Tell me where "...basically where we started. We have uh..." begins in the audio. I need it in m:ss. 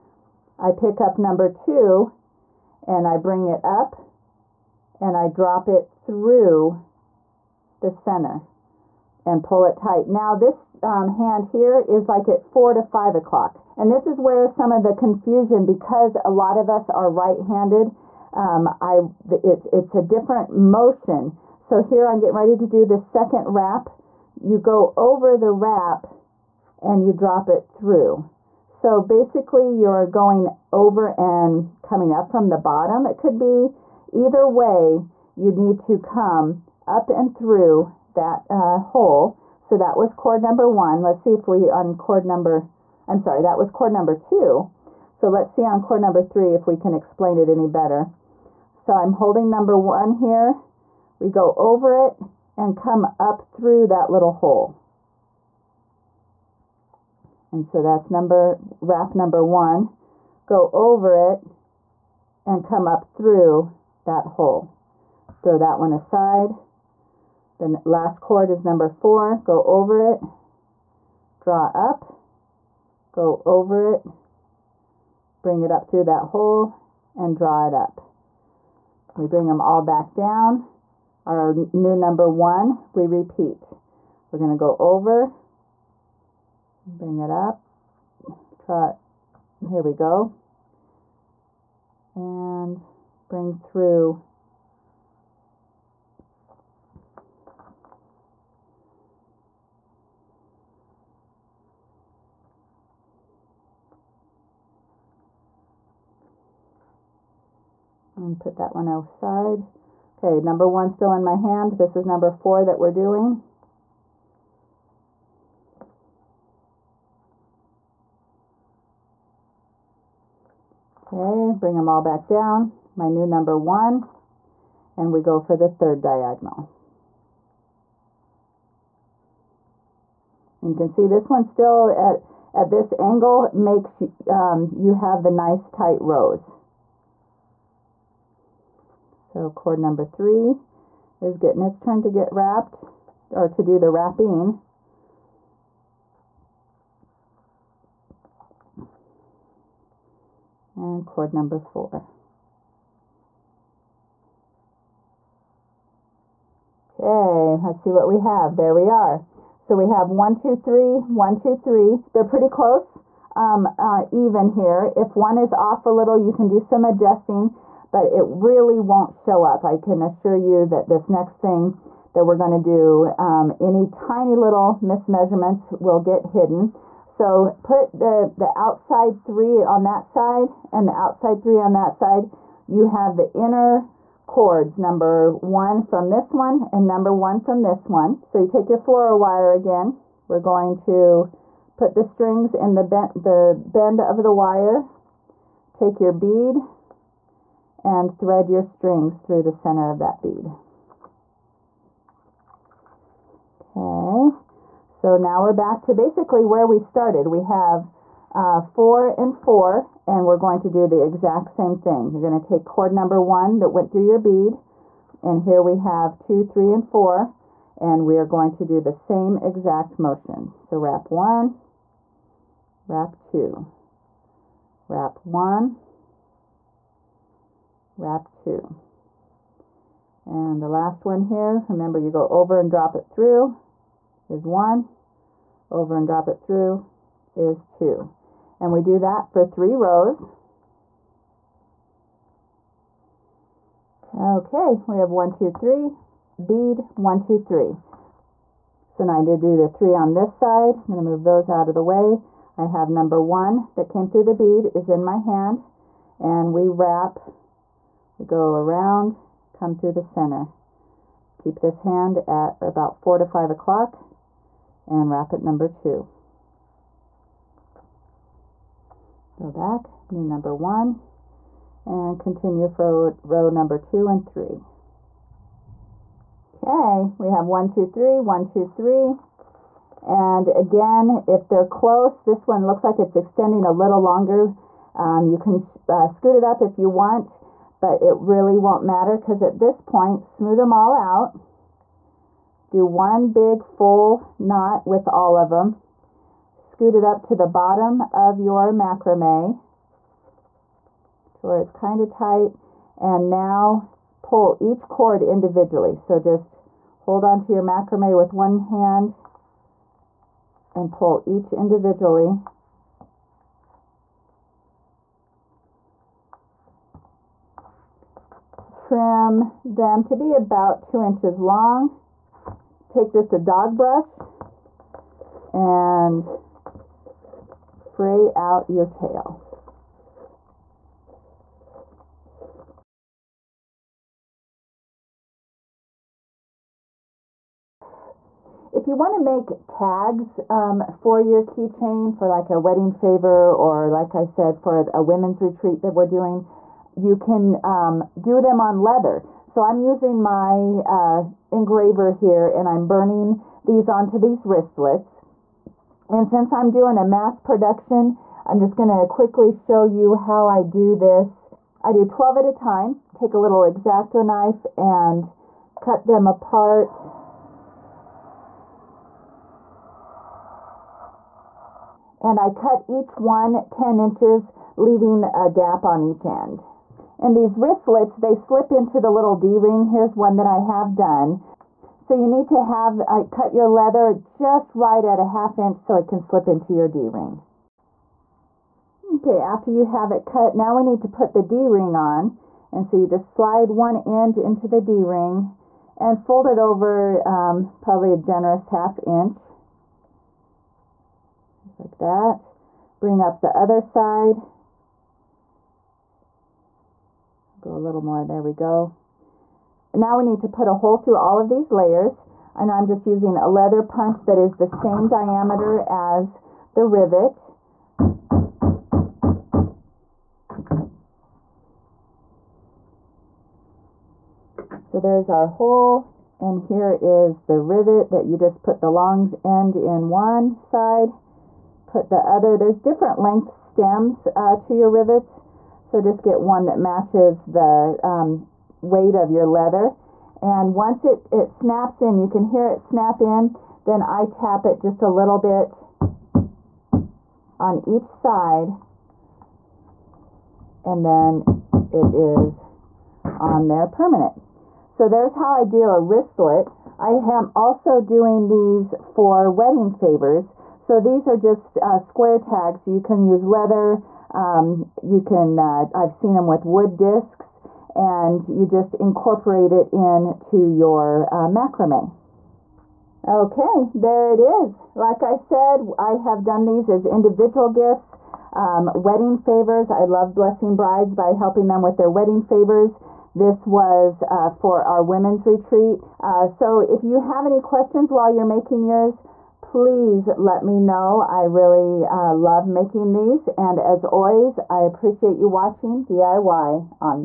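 3:25.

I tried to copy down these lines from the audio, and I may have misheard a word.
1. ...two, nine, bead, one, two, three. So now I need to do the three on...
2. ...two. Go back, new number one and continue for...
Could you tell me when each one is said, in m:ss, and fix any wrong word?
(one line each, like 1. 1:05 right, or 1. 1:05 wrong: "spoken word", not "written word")
1. 4:05 wrong: "three", not "nine"
2. 4:25 right.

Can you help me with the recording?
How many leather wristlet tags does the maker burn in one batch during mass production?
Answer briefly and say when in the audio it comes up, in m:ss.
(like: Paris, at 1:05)
12, at 6:02.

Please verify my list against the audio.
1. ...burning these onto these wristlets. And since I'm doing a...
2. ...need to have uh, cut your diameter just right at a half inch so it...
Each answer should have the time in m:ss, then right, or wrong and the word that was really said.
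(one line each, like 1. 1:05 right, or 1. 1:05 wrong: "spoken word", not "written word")
1. 5:52 right
2. 6:22 wrong: "leather", not "diameter".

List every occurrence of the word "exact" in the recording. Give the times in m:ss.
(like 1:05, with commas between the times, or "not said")
3:31, 3:39.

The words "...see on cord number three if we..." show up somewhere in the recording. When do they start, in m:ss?
0:45.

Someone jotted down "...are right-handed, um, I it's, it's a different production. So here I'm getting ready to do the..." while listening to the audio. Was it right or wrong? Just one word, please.
wrong.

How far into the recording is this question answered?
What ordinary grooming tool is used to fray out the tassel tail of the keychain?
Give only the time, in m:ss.
5:23.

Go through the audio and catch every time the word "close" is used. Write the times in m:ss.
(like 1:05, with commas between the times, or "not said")
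2:42, 4:41.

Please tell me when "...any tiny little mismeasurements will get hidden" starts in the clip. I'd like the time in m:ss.
2:53.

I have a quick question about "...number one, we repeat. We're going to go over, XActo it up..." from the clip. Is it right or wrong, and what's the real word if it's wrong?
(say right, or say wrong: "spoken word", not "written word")
wrong: "Bring", not "XActo".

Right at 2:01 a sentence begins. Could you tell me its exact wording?
Okay, bring them all back down.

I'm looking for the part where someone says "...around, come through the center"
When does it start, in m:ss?
4:18.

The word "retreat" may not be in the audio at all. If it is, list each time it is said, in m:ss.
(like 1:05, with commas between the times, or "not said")
5:45, 8:05.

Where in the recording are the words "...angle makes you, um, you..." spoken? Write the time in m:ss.
2:12.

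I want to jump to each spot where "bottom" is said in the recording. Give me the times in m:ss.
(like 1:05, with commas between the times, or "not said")
0:32, 4:57.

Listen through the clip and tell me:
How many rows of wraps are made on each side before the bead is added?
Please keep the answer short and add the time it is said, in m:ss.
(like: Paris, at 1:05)
3, at 3:59.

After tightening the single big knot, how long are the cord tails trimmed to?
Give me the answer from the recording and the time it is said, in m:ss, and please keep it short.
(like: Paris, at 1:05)
2 inches, at 5:20.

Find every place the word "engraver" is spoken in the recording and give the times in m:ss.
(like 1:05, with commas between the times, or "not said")
5:51.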